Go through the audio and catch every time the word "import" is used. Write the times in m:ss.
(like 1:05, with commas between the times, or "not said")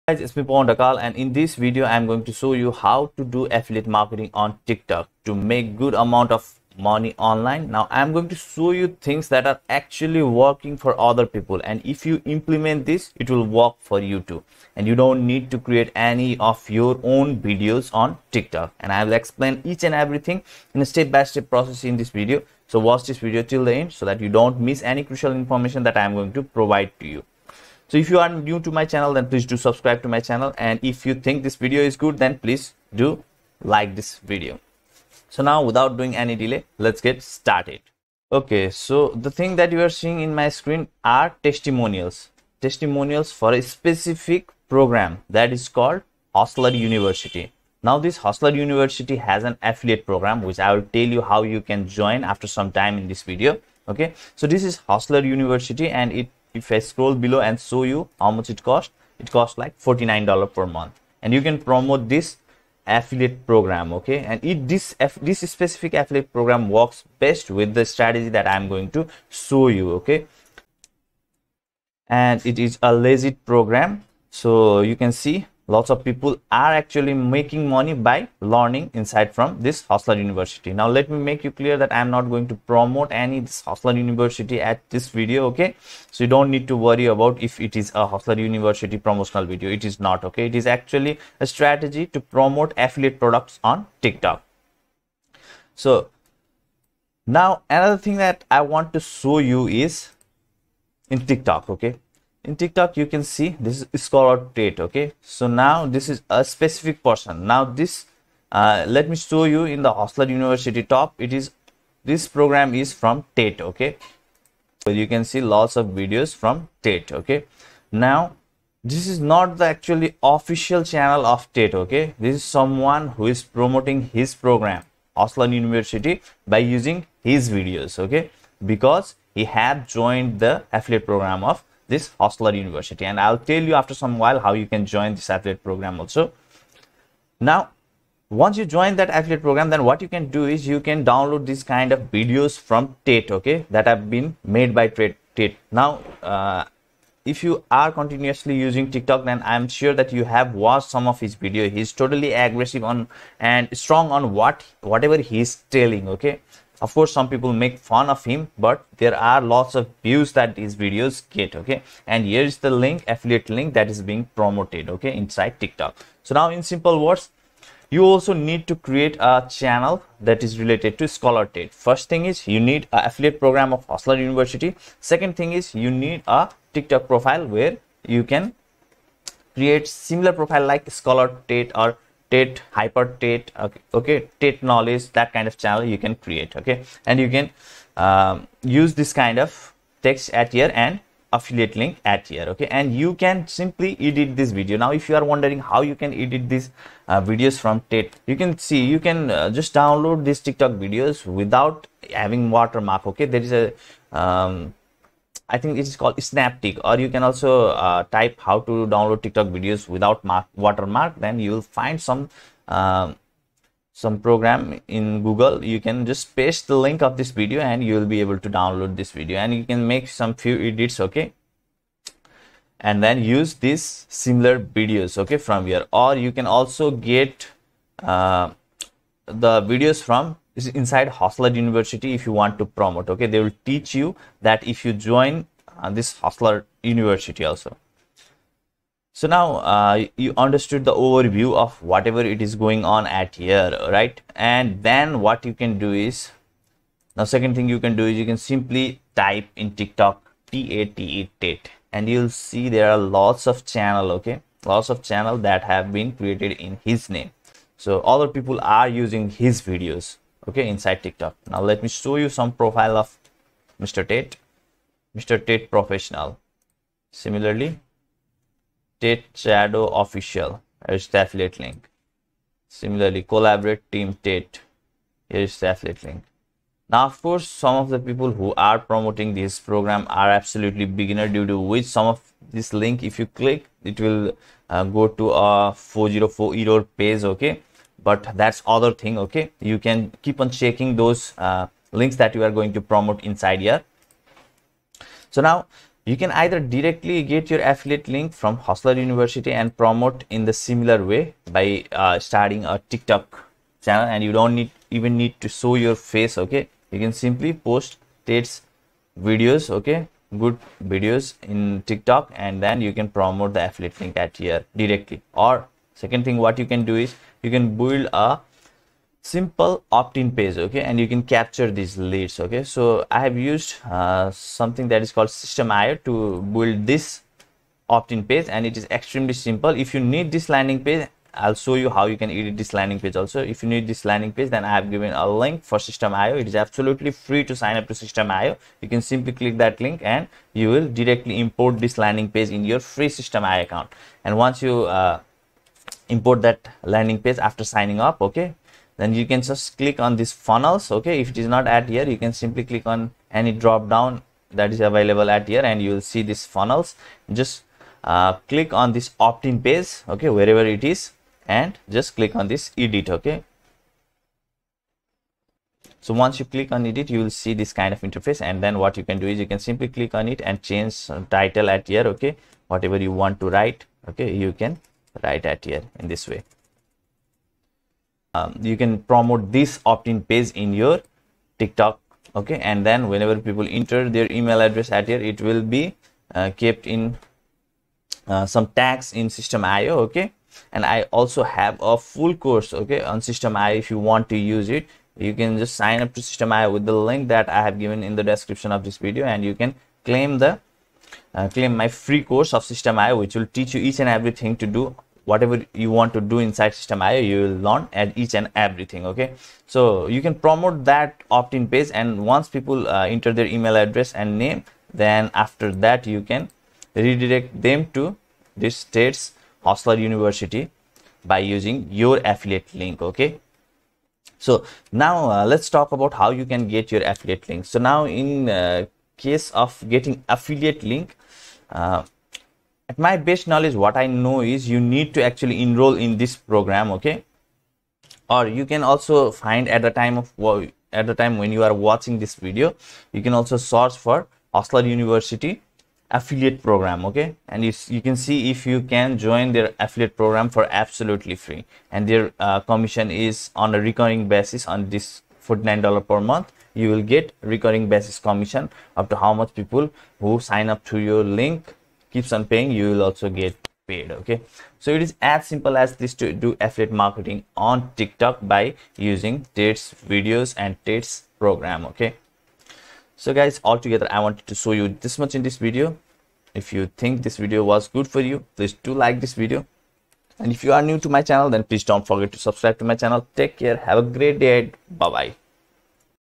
5:41, 5:46.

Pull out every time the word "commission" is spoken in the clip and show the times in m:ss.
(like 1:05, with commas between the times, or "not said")
7:32, 7:38.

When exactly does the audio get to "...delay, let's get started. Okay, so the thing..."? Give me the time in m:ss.
0:36.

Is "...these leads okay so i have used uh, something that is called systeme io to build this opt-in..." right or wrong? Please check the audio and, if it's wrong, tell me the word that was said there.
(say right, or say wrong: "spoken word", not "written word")
right.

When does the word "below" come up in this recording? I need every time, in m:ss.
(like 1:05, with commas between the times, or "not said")
0:57.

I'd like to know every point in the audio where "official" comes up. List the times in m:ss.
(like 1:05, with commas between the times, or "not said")
2:00, 4:30.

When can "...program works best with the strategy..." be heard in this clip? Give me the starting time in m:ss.
1:06.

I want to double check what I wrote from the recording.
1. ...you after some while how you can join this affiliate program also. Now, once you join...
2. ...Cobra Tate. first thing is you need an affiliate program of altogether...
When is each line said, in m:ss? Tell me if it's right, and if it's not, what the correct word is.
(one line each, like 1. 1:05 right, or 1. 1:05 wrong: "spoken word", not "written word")
1. 2:13 right
2. 2:51 wrong: "hustler", not "altogether".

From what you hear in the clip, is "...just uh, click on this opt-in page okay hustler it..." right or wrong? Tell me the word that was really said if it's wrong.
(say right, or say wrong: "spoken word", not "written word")
wrong: "wherever", not "hustler".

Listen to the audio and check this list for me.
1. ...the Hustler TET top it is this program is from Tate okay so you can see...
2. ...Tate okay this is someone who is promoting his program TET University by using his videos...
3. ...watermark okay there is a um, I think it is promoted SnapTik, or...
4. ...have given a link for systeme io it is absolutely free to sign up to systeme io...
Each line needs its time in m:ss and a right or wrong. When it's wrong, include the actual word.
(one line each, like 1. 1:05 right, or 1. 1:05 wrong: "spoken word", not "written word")
1. 1:49 wrong: "University", not "TET"
2. 2:01 wrong: "Hustler", not "TET"
3. 3:22 wrong: "called", not "promoted"
4. 5:34 right.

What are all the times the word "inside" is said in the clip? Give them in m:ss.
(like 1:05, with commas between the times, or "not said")
1:19, 2:45, 3:50, 4:20, 4:53, 6:46.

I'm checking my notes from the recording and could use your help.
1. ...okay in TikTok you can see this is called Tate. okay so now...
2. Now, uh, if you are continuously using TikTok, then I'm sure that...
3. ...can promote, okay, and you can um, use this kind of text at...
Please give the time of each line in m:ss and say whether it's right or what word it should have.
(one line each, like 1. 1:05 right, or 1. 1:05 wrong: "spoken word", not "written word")
1. 1:41 right
2. 2:25 right
3. 3:05 wrong: "create", not "promote".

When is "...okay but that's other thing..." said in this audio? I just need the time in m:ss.
4:47.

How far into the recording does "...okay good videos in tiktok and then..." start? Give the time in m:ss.
5:09.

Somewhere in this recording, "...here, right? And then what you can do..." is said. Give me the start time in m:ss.
4:03.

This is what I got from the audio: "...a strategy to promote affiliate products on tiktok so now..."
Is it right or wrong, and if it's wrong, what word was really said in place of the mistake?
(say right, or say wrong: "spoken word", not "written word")
right.